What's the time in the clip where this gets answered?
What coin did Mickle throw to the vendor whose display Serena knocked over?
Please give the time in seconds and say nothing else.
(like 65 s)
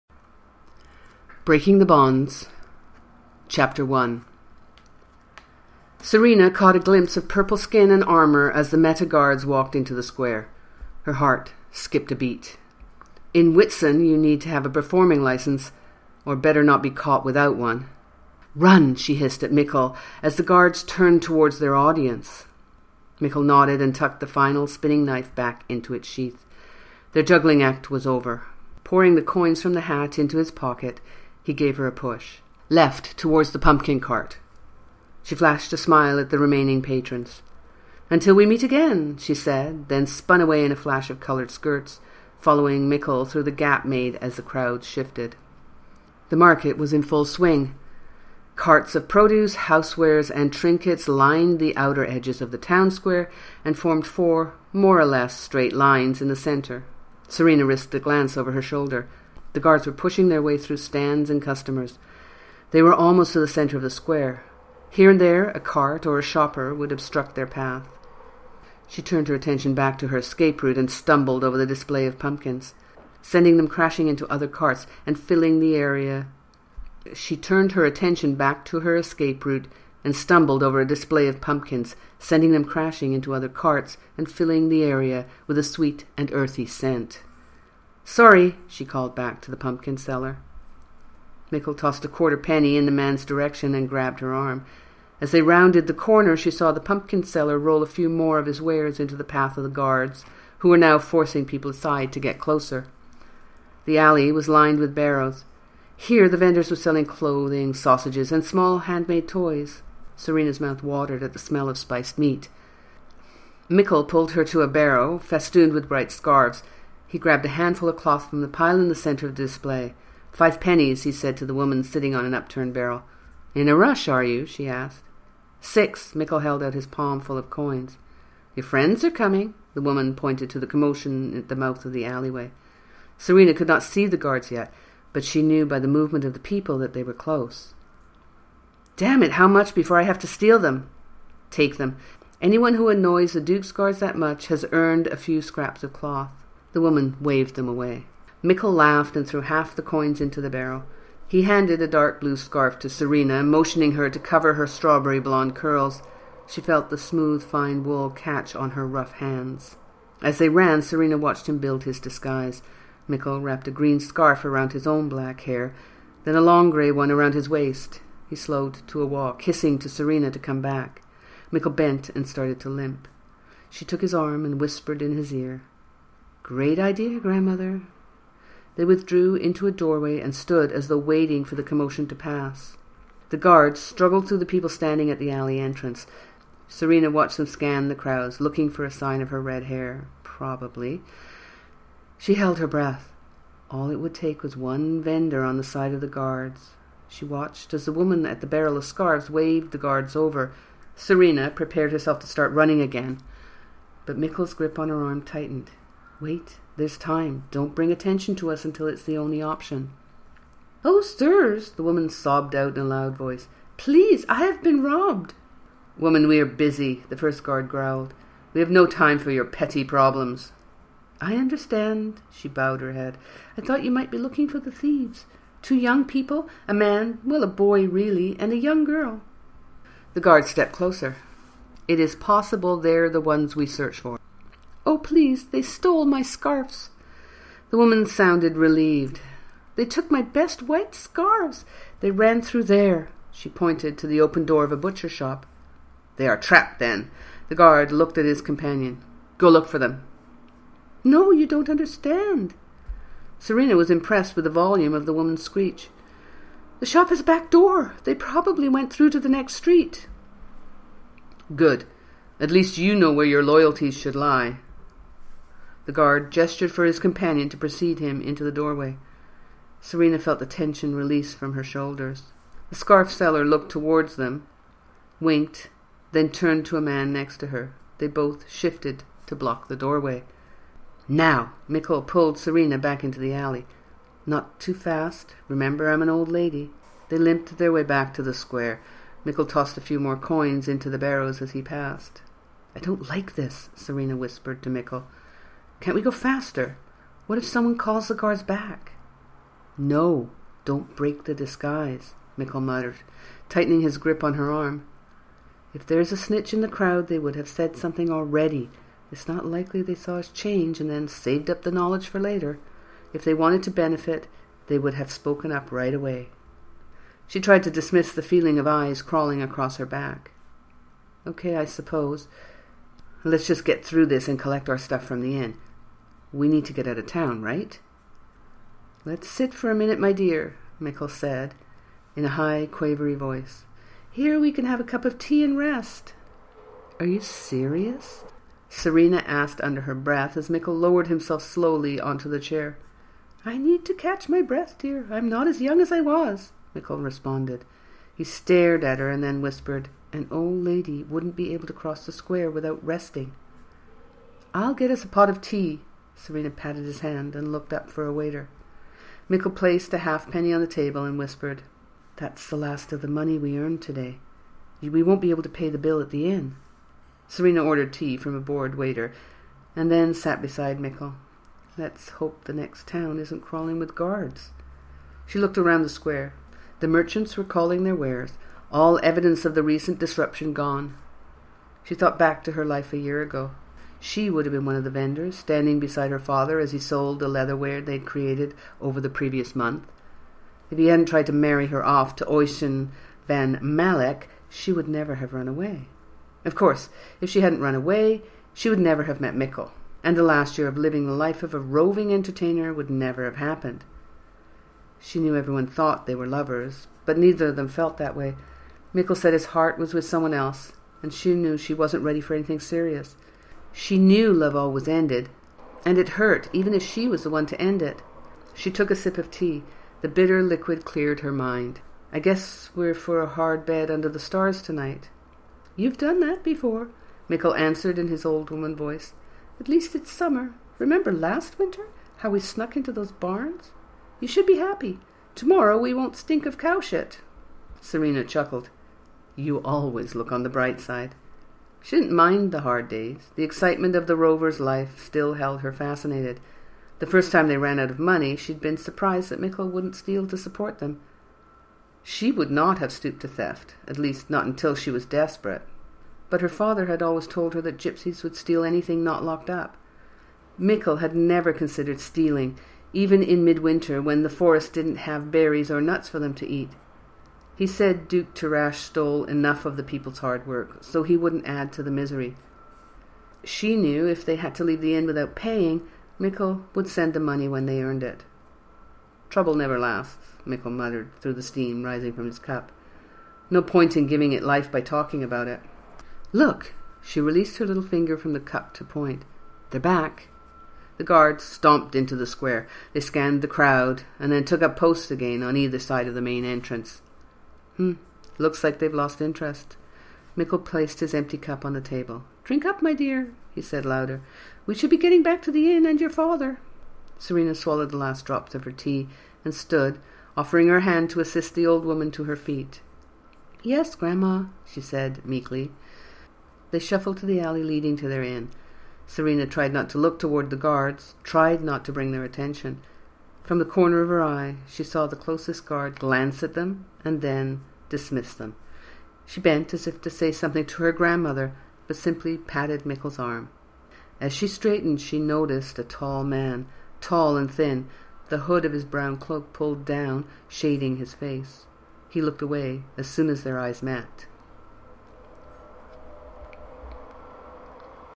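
92 s.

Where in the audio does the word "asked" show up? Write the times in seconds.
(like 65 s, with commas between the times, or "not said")
124 s, 339 s.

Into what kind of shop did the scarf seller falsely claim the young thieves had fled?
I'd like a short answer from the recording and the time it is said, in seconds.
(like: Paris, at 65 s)
Butcher shop, at 244 s.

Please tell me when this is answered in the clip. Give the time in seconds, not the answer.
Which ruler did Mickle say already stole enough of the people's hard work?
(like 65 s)
468 s.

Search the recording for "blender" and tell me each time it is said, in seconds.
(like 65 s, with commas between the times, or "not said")
not said.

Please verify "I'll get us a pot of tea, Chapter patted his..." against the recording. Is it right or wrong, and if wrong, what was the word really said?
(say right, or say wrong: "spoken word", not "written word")
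wrong: "Serena", not "Chapter".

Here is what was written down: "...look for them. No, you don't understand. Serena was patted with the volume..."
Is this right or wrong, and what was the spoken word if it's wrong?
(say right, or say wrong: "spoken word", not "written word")
wrong: "impressed", not "patted".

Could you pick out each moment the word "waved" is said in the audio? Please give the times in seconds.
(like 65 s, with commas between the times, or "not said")
147 s, 199 s.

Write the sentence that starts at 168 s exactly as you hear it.
He slowed to a walk, hissing to Serena to come back.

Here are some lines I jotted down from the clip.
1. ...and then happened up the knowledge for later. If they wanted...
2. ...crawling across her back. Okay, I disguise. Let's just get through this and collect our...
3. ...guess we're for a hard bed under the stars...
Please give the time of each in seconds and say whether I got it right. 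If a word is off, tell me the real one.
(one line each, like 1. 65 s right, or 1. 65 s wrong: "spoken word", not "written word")
1. 310 s wrong: "saved", not "happened"
2. 319 s wrong: "suppose", not "disguise"
3. 422 s right.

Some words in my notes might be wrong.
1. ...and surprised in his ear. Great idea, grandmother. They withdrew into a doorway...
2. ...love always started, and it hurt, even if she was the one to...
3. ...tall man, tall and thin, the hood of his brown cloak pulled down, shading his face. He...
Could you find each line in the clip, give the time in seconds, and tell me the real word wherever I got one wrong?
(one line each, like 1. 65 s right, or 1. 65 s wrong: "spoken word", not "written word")
1. 174 s wrong: "whispered", not "surprised"
2. 414 s wrong: "ended", not "started"
3. 535 s right.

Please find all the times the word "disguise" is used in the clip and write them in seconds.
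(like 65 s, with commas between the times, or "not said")
161 s, 301 s.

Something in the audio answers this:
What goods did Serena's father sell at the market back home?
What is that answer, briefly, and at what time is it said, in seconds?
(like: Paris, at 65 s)
Leatherware, at 387 s.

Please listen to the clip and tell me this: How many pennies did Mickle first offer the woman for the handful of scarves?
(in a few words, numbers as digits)
5.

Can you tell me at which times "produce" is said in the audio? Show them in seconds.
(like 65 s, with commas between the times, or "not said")
49 s.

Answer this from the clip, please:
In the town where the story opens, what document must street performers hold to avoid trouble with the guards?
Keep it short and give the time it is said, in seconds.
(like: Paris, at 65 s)
Performing license, at 14 s.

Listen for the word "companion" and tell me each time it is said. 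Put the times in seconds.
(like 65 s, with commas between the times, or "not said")
248 s, 266 s.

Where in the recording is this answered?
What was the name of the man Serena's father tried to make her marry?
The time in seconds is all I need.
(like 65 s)
392 s.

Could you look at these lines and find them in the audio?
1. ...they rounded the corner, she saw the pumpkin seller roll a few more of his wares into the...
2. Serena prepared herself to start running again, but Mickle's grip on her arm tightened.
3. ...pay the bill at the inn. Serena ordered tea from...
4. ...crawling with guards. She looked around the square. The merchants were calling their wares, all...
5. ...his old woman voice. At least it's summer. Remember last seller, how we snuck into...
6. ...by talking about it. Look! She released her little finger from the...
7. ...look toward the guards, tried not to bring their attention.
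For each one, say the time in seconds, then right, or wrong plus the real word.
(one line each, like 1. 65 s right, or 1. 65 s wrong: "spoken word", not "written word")
1. 95 s right
2. 200 s right
3. 365 s right
4. 373 s right
5. 428 s wrong: "winter", not "seller"
6. 484 s right
7. 519 s right.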